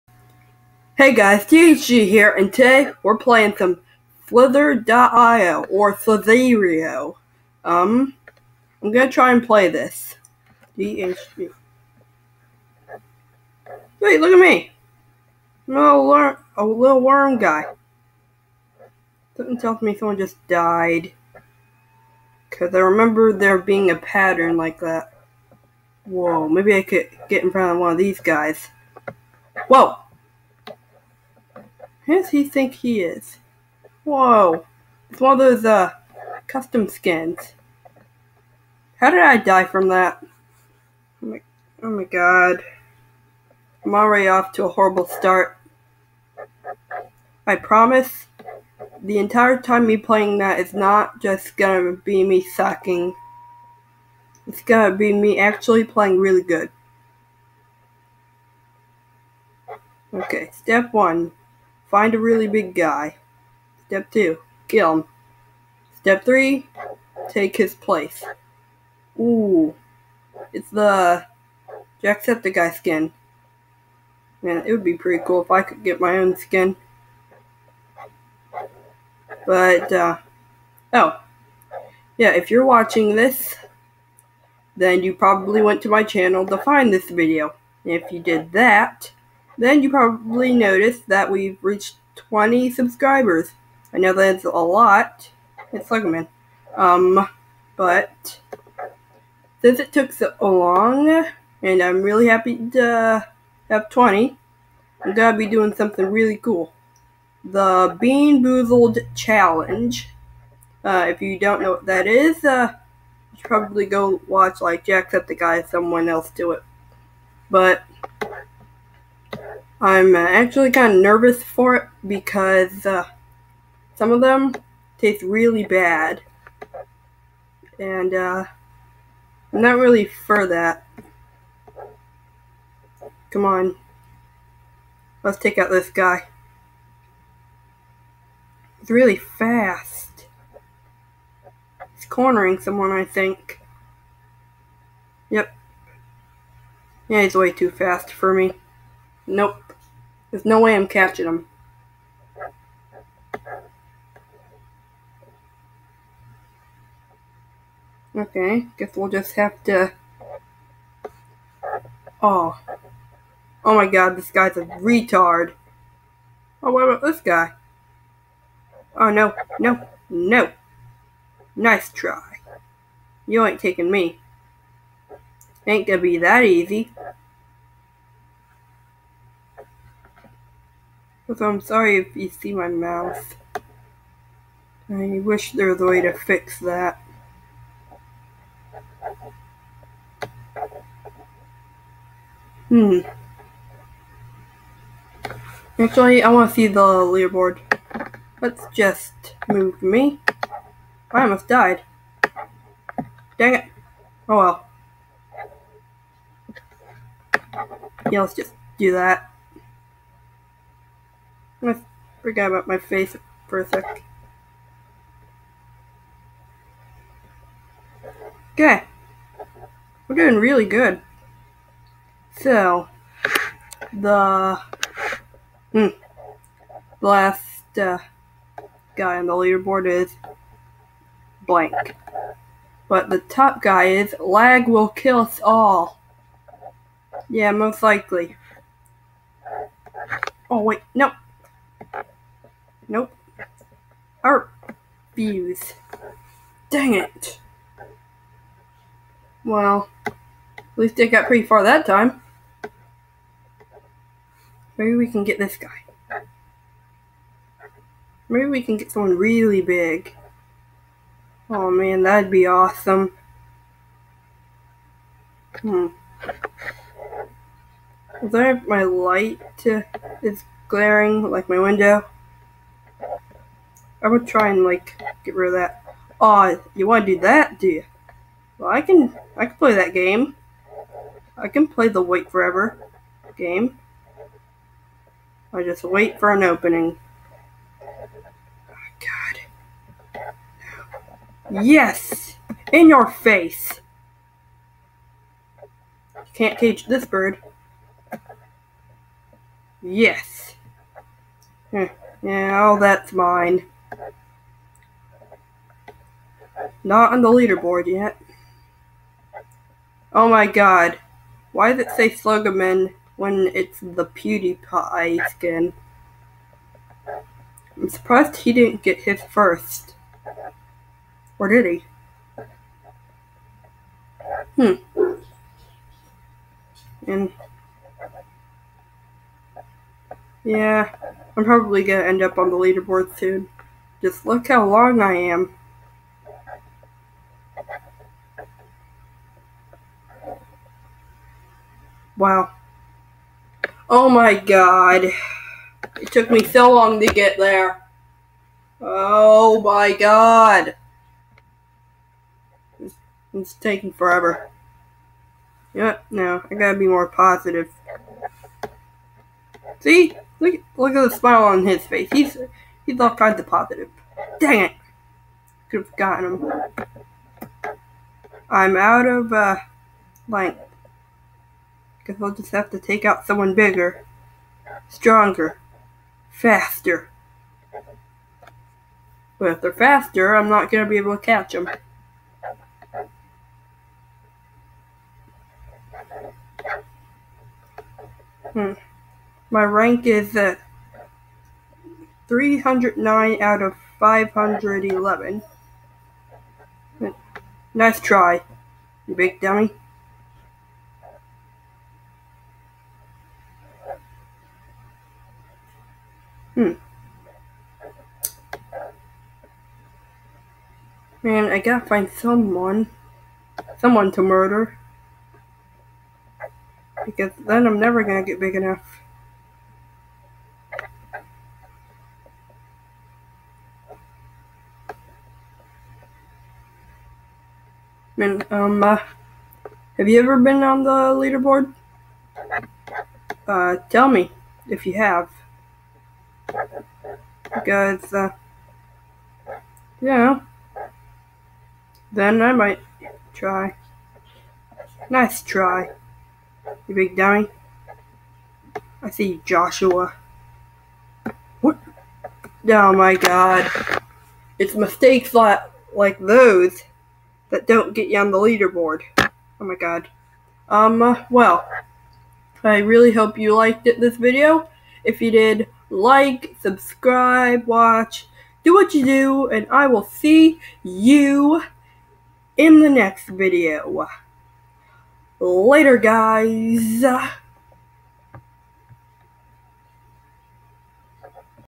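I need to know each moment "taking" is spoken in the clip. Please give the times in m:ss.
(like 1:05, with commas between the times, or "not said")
2:53, 5:53.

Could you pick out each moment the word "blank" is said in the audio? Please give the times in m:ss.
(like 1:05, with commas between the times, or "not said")
3:51.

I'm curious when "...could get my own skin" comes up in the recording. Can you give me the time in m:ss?
1:15.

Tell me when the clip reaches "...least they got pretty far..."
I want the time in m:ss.
4:10.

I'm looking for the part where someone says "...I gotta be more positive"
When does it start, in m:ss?
5:56.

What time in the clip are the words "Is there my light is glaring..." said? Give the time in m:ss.
4:28.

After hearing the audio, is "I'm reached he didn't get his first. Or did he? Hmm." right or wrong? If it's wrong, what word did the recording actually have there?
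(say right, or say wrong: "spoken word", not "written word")
wrong: "surprised", not "reached".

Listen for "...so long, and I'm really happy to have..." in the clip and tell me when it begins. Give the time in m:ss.
1:40.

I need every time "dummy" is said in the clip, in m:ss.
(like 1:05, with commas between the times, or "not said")
6:39, 7:27.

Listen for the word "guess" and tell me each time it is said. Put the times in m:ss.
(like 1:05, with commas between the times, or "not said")
2:38, 6:12.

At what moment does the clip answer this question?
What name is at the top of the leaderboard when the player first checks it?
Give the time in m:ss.
3:54.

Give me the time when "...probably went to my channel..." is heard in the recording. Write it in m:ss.
1:25.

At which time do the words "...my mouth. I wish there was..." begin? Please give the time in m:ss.
3:02.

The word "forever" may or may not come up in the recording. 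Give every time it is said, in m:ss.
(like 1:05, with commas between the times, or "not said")
4:42, 5:53.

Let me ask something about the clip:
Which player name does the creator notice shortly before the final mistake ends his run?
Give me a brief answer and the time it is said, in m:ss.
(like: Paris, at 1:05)
Joshua, at 7:29.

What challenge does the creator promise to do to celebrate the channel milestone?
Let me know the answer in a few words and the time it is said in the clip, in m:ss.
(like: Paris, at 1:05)
Bean Boozled Challenge, at 1:47.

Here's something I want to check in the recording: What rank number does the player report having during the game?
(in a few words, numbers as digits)
309.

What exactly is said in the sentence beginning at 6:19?
But if they're faster, I'm not going to be able to catch them.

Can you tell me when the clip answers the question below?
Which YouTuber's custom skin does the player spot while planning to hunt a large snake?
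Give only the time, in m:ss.
1:12.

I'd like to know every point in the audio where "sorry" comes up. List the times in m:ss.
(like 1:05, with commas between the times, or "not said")
3:01.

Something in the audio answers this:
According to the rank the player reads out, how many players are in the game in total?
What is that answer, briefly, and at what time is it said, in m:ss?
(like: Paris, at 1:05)
511, at 6:33.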